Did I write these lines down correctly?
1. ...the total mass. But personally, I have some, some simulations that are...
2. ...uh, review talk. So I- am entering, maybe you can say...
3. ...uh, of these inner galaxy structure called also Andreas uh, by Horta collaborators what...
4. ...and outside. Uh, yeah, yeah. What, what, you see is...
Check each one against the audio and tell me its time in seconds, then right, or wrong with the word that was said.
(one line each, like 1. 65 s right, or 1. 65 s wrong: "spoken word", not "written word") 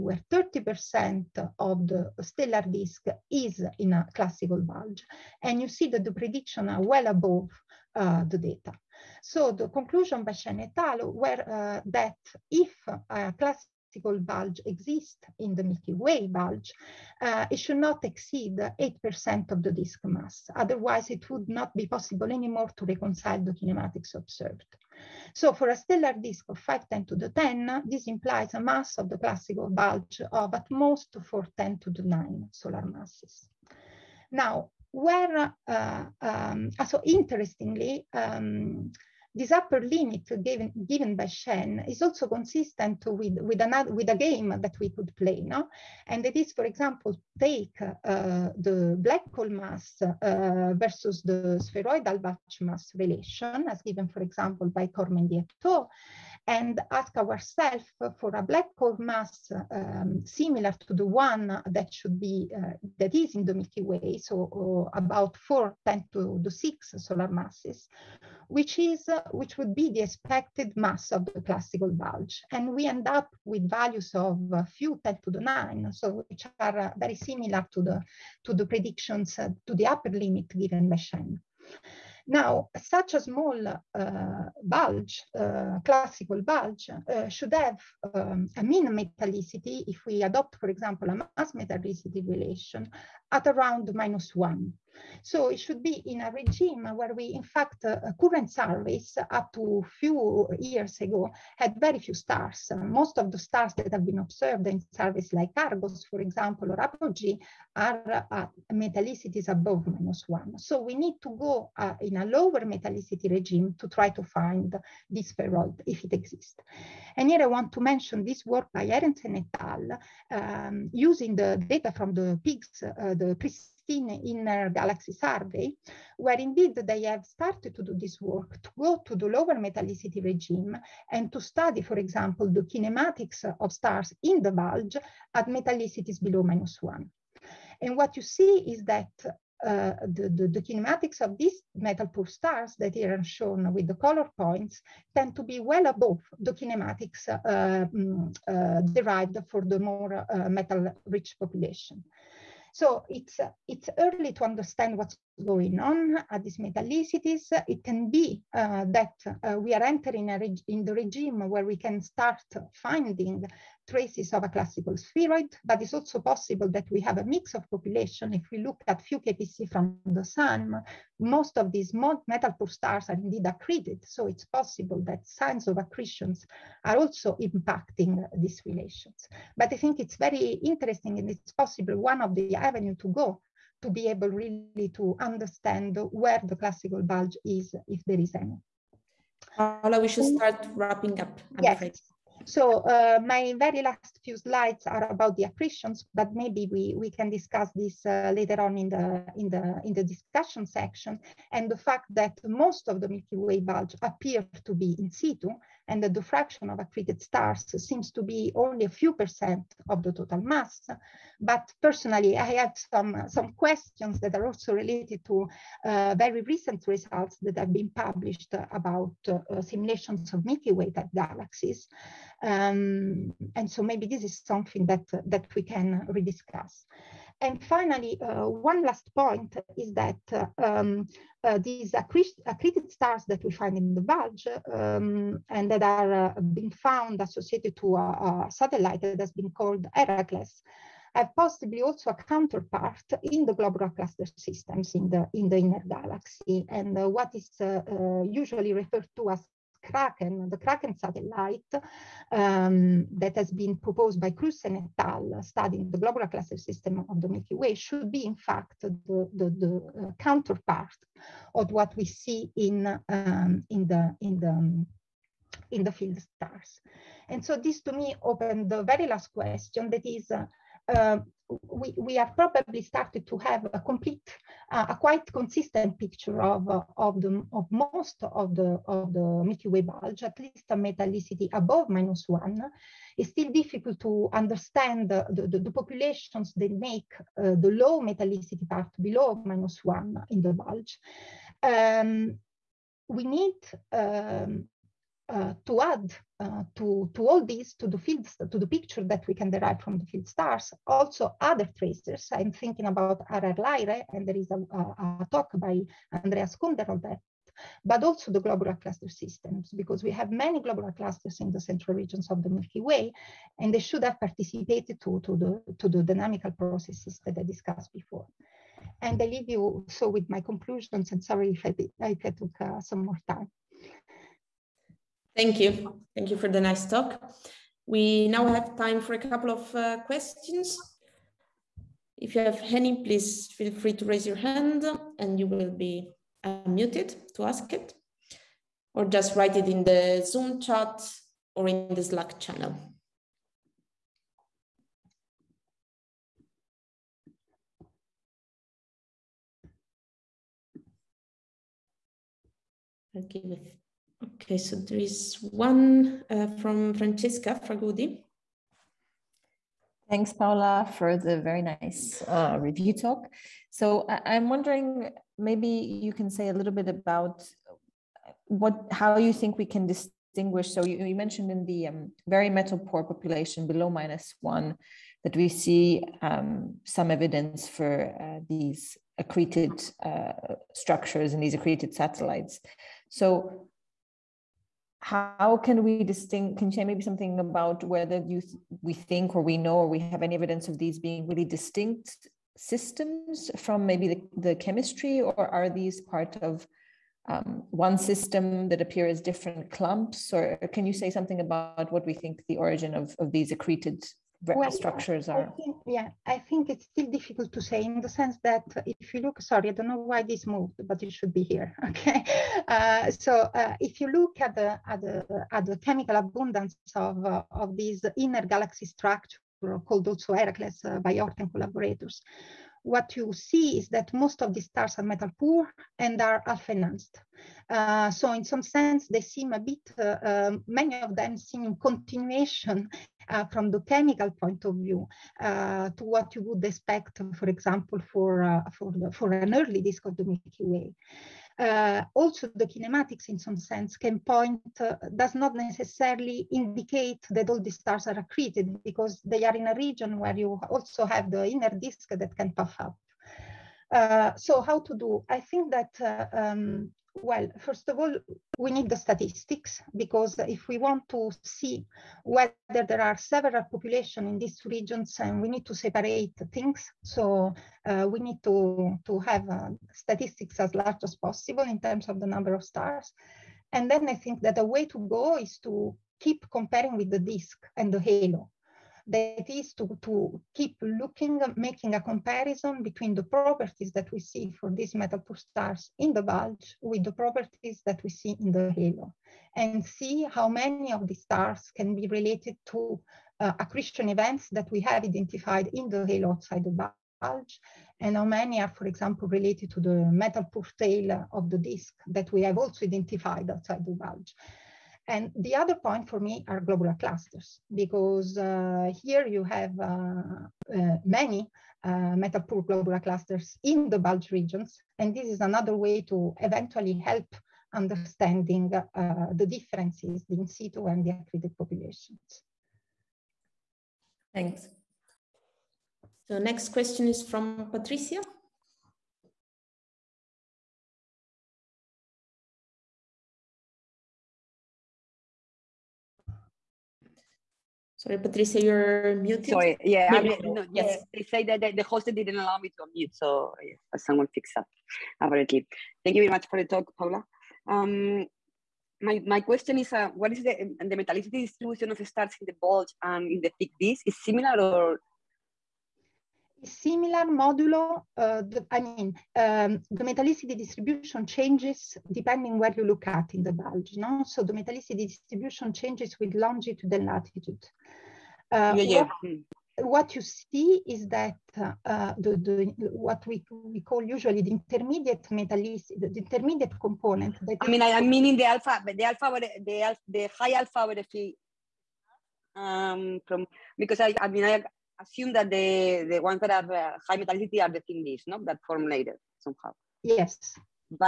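1. 210 s wrong: "questions", not "simulations"
2. 362 s wrong: "wondering", not "entering"
3. 417 s wrong: "Heracles", not "Andreas"
4. 566 s wrong: "latitude", not "outside".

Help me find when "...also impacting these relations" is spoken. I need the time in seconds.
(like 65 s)
176 s.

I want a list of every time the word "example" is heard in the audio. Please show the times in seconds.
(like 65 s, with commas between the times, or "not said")
46 s, 54 s, 90 s, 106 s, 131 s, 437 s, 498 s.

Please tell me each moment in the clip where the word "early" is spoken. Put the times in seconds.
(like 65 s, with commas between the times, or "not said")
153 s, 439 s.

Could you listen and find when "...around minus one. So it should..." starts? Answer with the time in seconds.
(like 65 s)
93 s.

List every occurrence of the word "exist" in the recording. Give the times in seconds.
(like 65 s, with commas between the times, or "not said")
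14 s, 116 s.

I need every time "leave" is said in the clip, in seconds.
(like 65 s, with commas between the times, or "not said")
319 s, 588 s.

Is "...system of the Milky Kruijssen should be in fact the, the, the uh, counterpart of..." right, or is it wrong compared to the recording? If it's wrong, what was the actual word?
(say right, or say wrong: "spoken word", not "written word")
wrong: "Way", not "Kruijssen".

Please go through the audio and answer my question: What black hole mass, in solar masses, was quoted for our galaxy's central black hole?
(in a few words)
4 × 10^6.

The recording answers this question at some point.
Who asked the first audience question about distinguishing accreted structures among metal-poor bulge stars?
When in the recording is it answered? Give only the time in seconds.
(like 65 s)
356 s.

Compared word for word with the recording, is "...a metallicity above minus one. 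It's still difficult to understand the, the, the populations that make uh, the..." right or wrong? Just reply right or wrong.
right.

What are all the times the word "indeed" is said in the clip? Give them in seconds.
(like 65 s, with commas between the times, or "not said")
126 s, 173 s.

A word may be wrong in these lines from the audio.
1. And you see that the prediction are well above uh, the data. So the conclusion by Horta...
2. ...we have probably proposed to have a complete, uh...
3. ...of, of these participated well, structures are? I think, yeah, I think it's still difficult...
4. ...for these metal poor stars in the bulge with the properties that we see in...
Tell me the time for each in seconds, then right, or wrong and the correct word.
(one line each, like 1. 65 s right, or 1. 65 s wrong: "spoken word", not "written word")
1. 5 s wrong: "Shen", not "Horta"
2. 271 s wrong: "started", not "proposed"
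3. 402 s wrong: "accreted", not "participated"
4. 484 s right.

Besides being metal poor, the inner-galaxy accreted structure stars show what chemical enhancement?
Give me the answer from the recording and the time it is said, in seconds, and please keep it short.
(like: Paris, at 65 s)
alpha-enhanced, at 426 s.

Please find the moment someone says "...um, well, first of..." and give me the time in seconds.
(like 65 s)
456 s.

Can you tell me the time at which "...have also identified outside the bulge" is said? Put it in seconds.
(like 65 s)
502 s.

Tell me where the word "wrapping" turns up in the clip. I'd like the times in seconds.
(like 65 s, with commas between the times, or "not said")
190 s.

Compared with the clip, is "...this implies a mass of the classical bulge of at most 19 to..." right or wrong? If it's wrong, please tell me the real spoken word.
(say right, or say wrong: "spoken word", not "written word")
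wrong: "10", not "19".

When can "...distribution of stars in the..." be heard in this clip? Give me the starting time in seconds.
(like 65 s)
551 s.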